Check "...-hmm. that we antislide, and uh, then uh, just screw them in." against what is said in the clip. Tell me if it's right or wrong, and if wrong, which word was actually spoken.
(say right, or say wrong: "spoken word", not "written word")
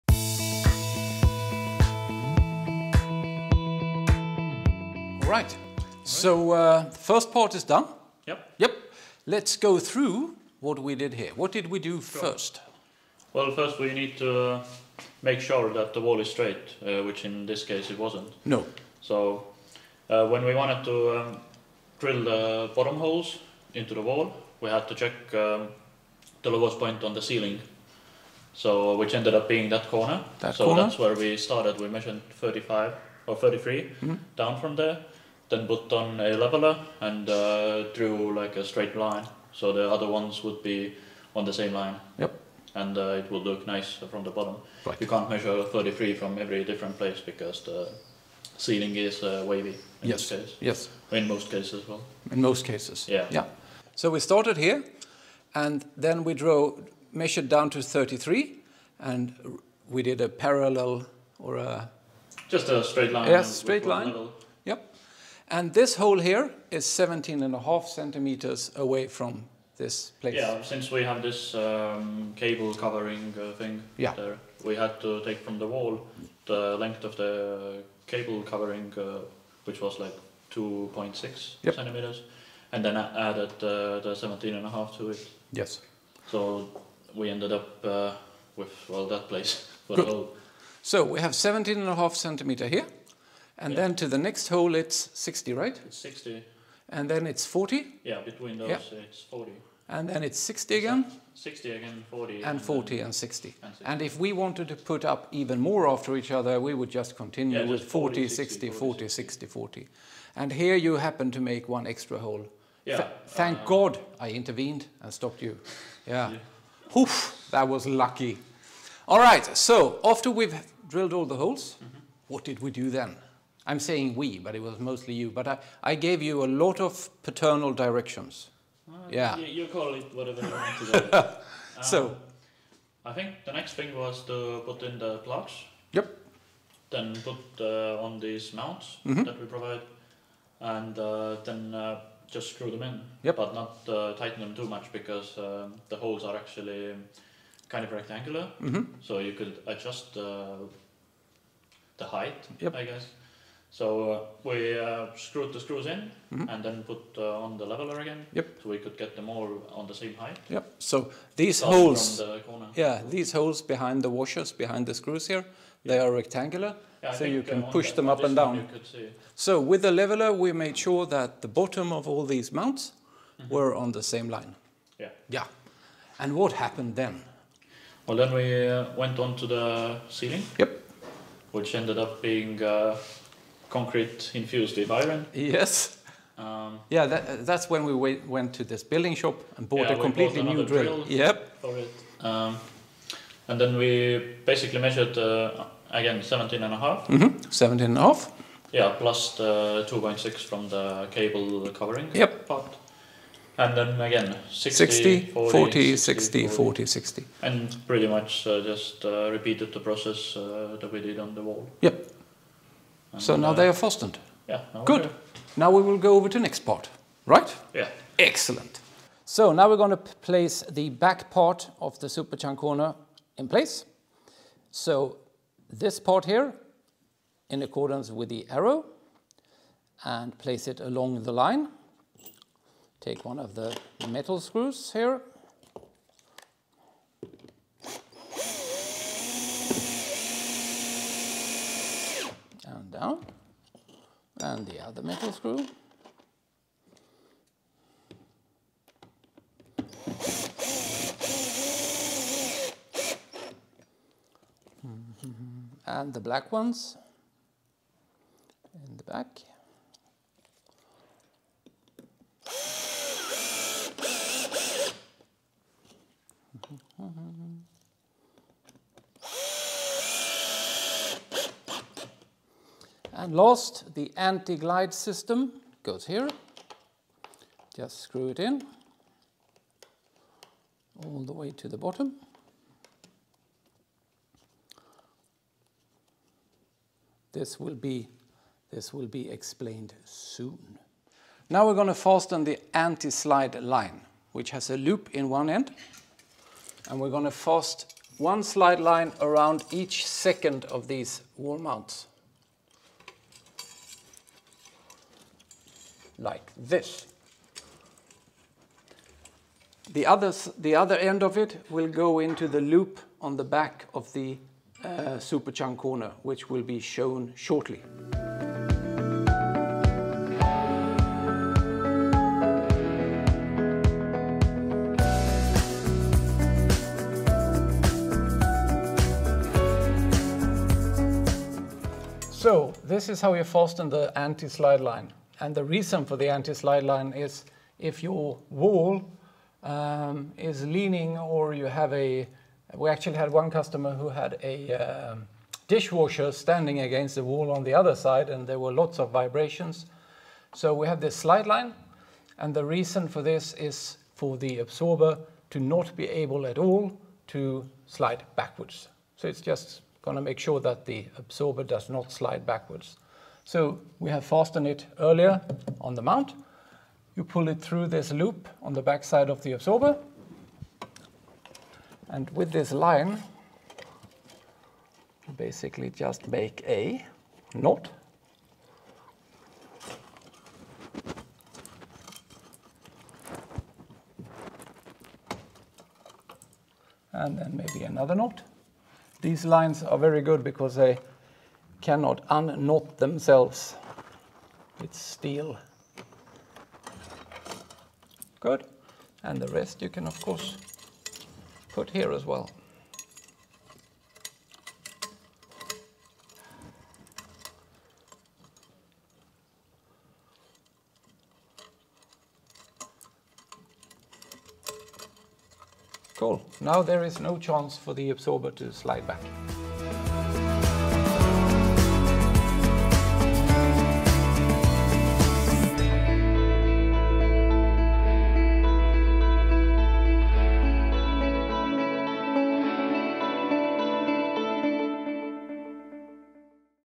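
wrong: "provide", not "antislide".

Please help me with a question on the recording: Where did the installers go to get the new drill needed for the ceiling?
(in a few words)
building shop.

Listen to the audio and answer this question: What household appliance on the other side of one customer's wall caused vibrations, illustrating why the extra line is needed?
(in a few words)
dishwasher.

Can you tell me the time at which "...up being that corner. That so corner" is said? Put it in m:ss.
0:29.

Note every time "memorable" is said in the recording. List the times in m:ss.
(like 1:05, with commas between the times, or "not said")
not said.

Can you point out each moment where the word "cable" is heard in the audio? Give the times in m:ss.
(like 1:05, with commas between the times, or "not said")
1:12, 1:18, 3:21.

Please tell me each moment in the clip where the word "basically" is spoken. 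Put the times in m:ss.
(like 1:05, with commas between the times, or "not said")
3:14, 6:15.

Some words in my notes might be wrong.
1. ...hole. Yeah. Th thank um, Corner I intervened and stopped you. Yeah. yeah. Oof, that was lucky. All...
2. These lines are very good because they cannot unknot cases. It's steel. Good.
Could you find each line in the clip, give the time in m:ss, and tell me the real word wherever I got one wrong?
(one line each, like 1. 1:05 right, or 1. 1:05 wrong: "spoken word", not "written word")
1. 1:52 wrong: "God", not "Corner"
2. 6:29 wrong: "themselves", not "cases".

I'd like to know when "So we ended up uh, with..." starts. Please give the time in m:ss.
1:26.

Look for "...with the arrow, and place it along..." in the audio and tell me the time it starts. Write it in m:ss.
3:48.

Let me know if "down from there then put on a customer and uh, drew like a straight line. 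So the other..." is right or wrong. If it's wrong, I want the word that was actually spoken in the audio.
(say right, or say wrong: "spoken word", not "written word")
wrong: "leveler", not "customer".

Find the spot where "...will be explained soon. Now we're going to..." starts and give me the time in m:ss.
4:48.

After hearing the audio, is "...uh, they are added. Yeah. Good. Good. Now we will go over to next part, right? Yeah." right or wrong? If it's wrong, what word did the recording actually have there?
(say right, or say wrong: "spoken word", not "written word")
wrong: "fastened", not "added".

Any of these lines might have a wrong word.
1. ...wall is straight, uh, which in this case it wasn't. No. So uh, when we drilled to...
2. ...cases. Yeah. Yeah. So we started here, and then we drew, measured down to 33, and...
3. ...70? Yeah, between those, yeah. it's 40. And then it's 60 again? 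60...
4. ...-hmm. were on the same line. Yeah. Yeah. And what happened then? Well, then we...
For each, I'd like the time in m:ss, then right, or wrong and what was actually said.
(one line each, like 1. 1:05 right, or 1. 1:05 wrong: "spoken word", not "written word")
1. 0:16 wrong: "wanted", not "drilled"
2. 0:52 right
3. 1:37 wrong: "40", not "70"
4. 2:53 right.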